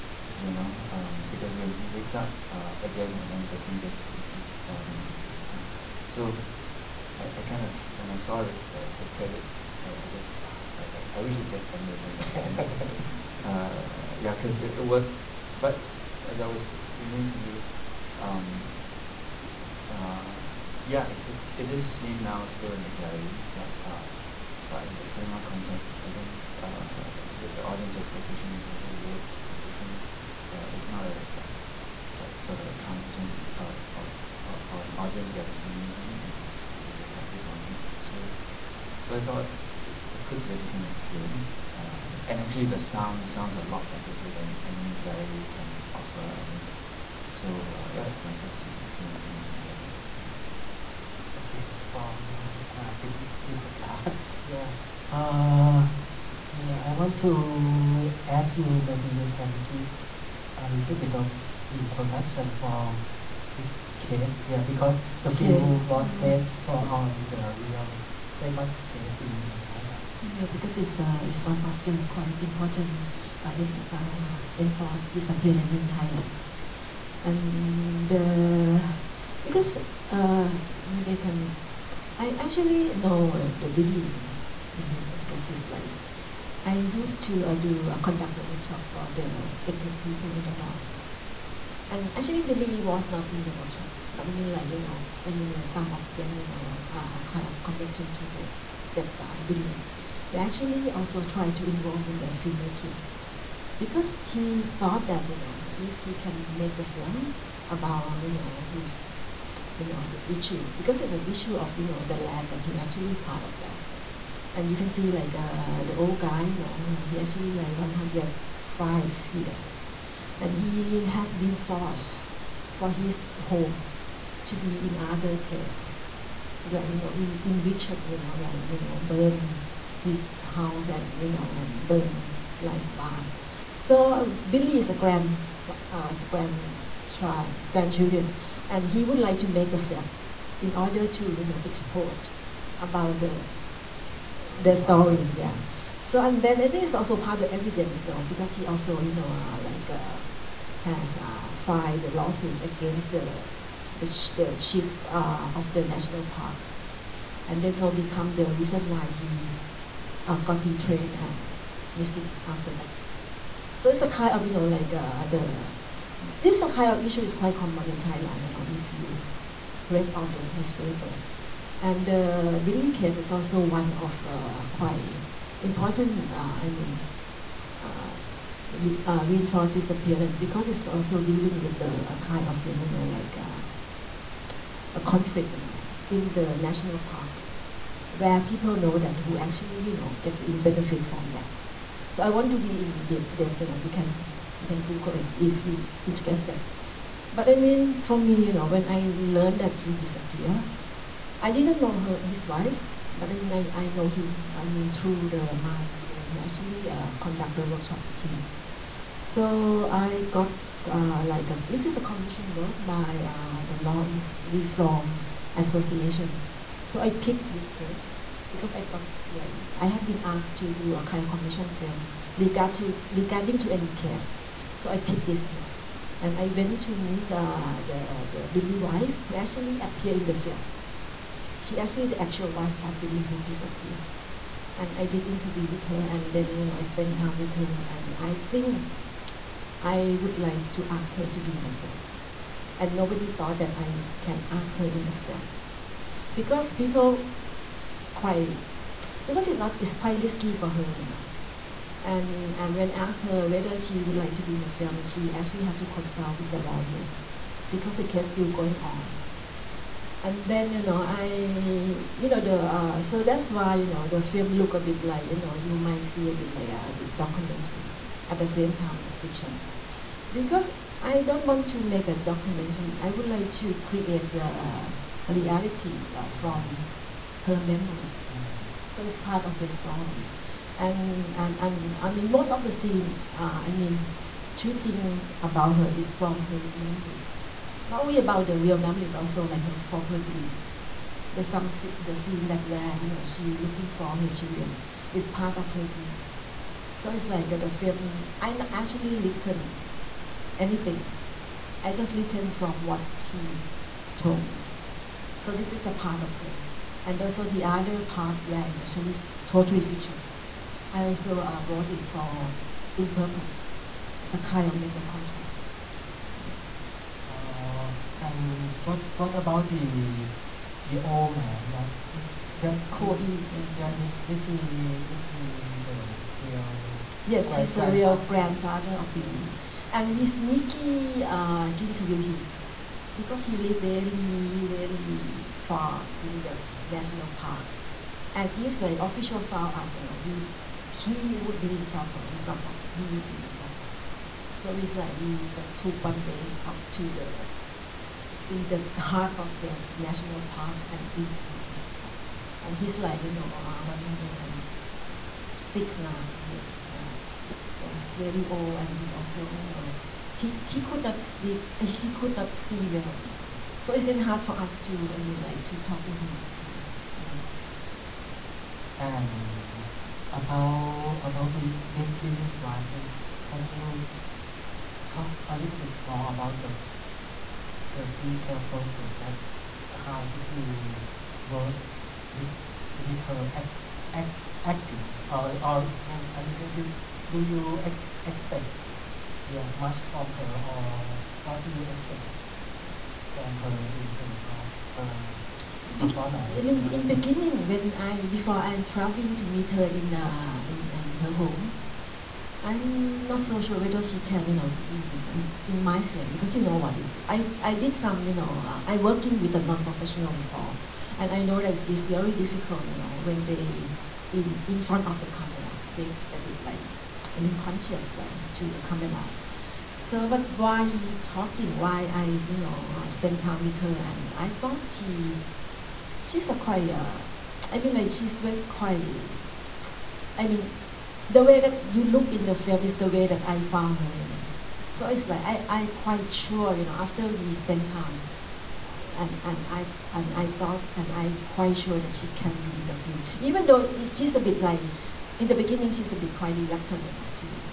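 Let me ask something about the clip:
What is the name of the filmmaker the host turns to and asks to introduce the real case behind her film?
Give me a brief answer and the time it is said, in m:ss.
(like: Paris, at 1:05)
Pimpaka, at 0:53.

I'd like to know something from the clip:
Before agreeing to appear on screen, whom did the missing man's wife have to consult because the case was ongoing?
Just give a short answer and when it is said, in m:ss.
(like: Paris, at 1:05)
the lawyer, at 4:16.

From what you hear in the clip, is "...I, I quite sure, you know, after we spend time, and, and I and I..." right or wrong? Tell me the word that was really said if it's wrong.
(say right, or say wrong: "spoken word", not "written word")
right.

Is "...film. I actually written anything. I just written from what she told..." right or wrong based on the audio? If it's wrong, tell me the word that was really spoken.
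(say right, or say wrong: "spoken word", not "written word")
right.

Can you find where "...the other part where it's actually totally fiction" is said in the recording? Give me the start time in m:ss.
5:07.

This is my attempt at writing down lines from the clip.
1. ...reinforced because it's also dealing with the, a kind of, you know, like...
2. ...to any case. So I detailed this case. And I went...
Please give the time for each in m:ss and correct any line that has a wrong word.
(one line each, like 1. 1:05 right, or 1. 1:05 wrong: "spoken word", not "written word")
1. 2:59 right
2. 3:43 wrong: "picked", not "detailed".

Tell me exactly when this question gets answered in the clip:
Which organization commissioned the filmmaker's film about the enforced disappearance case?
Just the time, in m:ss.
3:33.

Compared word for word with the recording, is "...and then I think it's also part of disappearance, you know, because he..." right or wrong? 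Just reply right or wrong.
wrong.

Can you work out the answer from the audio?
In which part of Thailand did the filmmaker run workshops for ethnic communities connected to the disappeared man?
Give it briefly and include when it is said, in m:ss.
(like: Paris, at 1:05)
the north, at 1:30.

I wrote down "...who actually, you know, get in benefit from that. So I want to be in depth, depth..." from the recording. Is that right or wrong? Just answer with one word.
right.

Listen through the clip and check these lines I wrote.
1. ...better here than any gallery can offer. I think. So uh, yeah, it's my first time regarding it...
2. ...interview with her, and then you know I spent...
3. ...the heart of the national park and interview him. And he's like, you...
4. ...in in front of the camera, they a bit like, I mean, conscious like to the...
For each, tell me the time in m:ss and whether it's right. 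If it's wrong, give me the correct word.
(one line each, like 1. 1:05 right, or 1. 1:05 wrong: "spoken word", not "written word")
1. 0:43 wrong: "experiencing", not "regarding"
2. 3:55 right
3. 5:48 right
4. 6:54 right.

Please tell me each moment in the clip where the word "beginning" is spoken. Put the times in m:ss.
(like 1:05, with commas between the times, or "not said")
6:37, 7:25.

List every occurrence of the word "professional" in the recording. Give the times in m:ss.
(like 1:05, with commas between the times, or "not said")
6:49.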